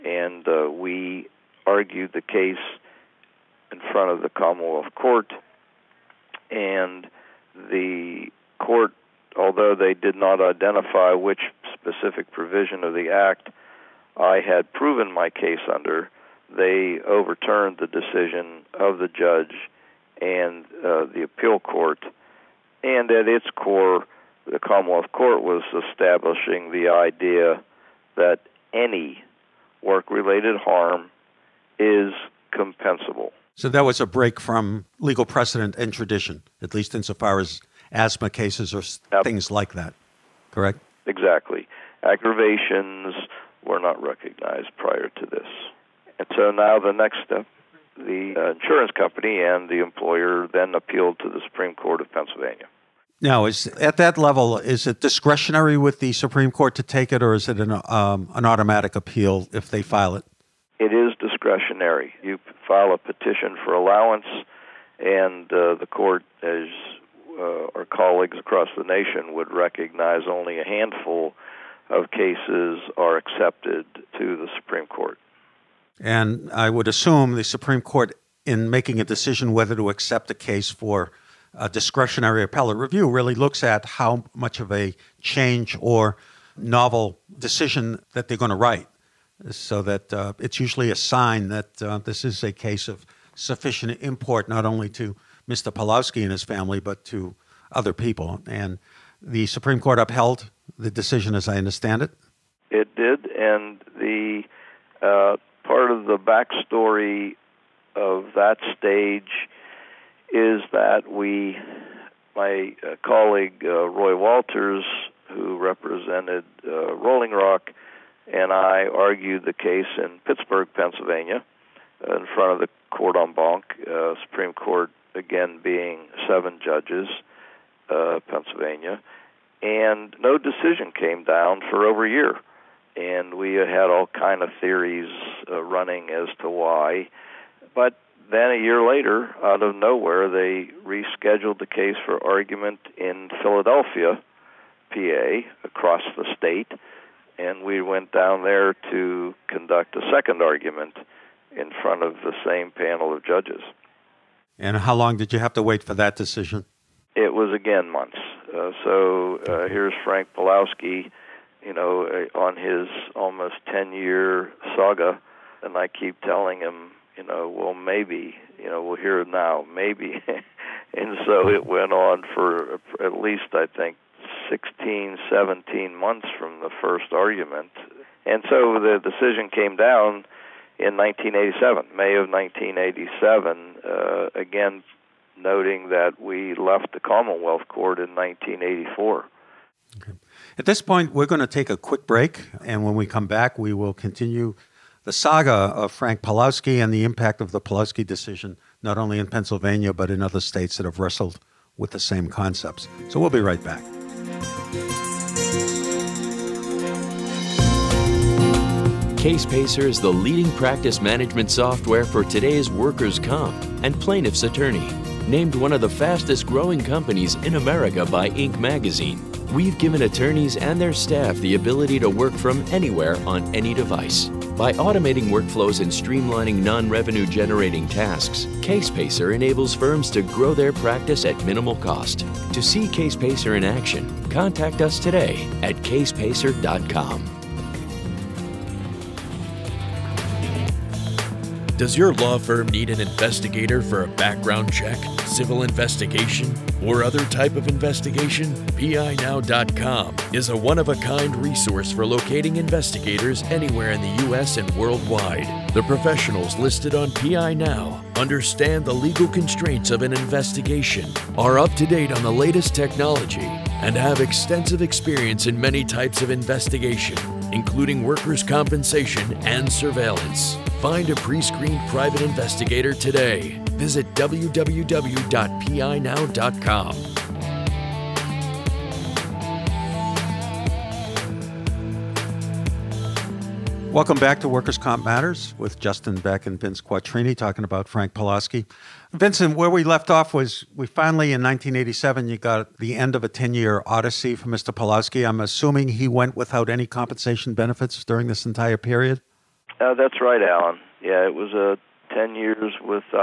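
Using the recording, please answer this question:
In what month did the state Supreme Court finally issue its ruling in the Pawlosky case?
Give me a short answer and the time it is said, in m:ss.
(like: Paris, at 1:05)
May, at 3:01.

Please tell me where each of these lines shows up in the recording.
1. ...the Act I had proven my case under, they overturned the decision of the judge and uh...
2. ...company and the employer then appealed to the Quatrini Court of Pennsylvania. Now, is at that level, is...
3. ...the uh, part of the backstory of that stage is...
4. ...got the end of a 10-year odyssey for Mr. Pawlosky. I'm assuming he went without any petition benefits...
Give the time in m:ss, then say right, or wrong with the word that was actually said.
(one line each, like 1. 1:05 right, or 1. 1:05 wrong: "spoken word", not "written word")
1. 0:12 right
2. 0:48 wrong: "Supreme", not "Quatrini"
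3. 1:43 right
4. 4:52 wrong: "compensation", not "petition".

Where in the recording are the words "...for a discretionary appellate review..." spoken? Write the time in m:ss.
1:20.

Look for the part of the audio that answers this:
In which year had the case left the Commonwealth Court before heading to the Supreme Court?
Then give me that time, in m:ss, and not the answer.
3:08.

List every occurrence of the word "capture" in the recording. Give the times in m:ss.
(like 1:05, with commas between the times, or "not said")
not said.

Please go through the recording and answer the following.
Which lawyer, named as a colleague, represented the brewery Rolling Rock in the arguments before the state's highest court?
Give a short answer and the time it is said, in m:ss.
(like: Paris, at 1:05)
Roy Walters, at 1:53.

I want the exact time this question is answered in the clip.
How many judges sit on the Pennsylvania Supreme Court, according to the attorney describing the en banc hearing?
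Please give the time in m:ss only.
2:06.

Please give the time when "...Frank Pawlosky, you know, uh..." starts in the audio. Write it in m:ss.
2:40.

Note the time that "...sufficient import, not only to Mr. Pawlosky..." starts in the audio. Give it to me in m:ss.
1:33.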